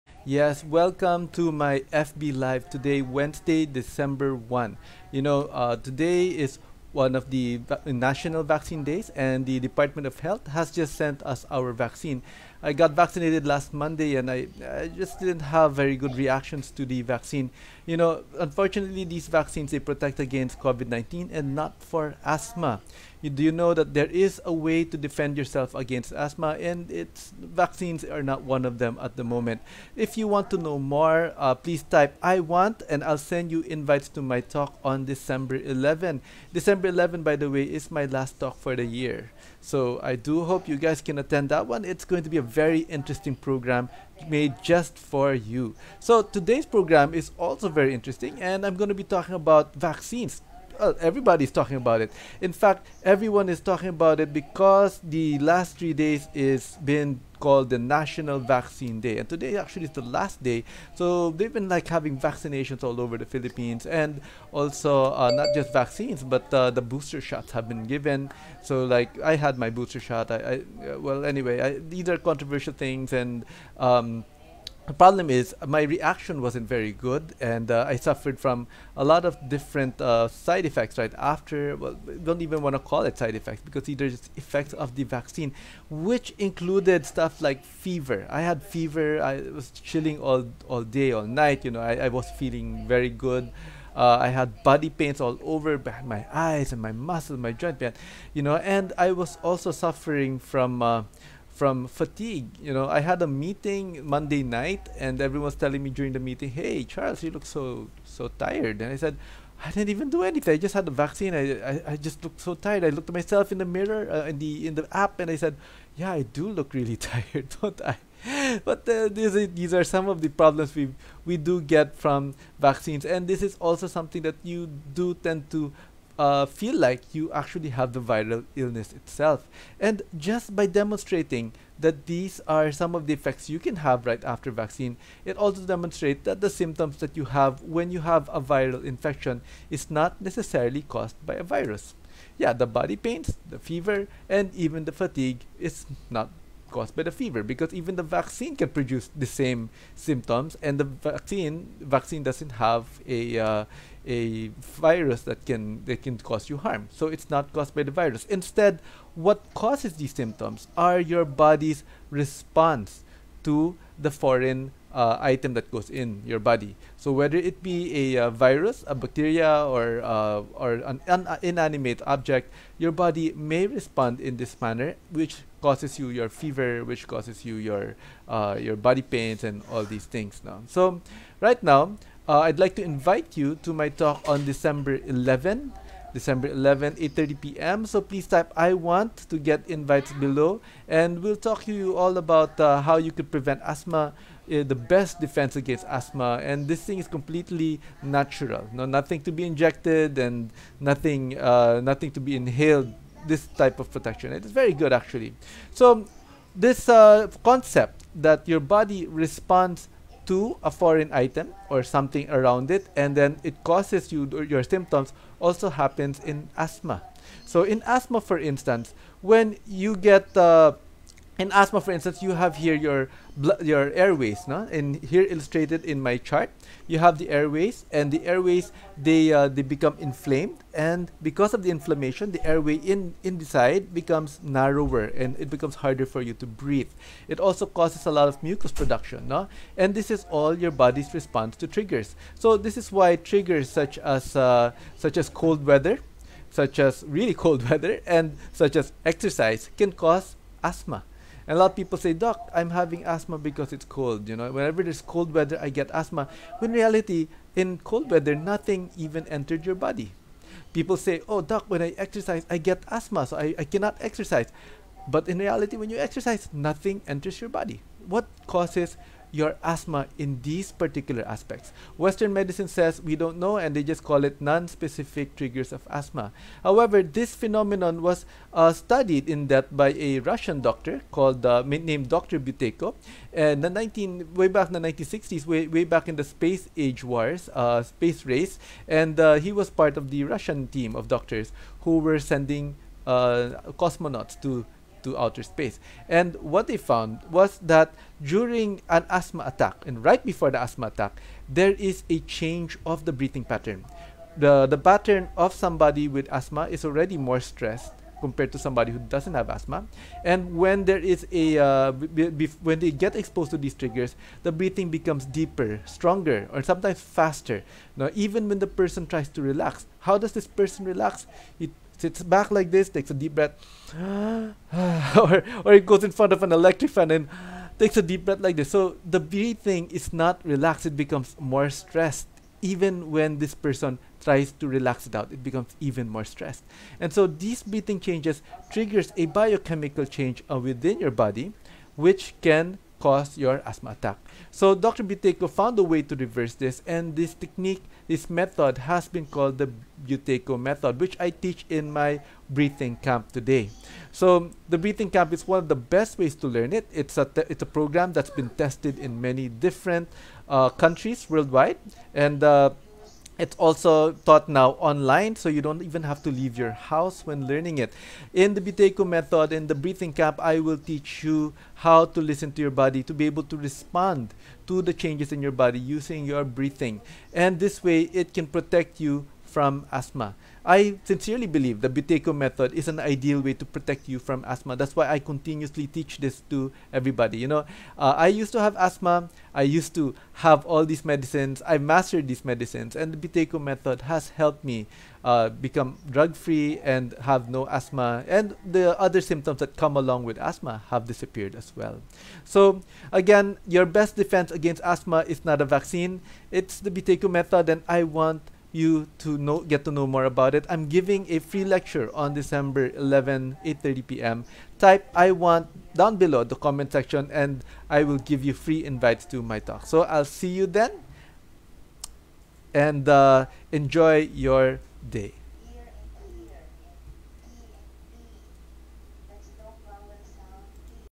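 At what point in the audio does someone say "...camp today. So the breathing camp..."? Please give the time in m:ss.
5:52.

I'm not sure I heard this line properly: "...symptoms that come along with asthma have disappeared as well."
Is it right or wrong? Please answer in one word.
right.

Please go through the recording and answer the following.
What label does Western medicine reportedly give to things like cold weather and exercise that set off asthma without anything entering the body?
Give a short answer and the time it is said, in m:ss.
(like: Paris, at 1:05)
non-specific triggers, at 4:34.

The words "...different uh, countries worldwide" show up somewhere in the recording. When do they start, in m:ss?
5:59.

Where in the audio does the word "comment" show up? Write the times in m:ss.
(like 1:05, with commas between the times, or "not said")
6:56.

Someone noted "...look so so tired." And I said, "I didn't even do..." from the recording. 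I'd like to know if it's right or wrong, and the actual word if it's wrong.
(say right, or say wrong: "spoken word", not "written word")
right.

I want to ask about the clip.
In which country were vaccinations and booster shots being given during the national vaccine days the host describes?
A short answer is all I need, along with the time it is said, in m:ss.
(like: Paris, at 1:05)
Philippines, at 1:03.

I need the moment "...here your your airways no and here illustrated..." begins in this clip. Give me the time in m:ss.
3:42.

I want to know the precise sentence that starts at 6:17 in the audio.
And this way, it can protect you from asthma.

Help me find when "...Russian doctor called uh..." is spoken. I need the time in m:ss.
4:40.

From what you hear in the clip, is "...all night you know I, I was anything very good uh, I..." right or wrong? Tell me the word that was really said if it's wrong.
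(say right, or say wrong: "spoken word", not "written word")
wrong: "feeling", not "anything".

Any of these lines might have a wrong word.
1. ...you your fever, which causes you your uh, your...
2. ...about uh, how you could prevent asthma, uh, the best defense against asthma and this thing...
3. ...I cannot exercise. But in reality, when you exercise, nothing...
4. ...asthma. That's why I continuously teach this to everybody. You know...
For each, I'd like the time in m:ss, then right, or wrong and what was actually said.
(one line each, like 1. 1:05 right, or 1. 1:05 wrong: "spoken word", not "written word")
1. 2:55 right
2. 3:12 right
3. 4:23 right
4. 6:24 right.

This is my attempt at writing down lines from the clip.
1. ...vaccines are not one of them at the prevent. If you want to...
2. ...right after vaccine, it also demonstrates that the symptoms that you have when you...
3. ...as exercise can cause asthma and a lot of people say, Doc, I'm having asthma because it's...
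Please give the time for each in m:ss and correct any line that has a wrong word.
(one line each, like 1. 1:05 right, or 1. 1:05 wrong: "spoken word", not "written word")
1. 0:27 wrong: "moment", not "prevent"
2. 2:14 right
3. 4:08 right.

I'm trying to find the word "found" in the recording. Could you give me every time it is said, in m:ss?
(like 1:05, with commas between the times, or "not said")
4:56, 5:45.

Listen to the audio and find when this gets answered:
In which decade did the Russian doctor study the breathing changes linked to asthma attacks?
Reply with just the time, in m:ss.
4:44.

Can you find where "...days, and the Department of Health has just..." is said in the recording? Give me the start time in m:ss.
0:08.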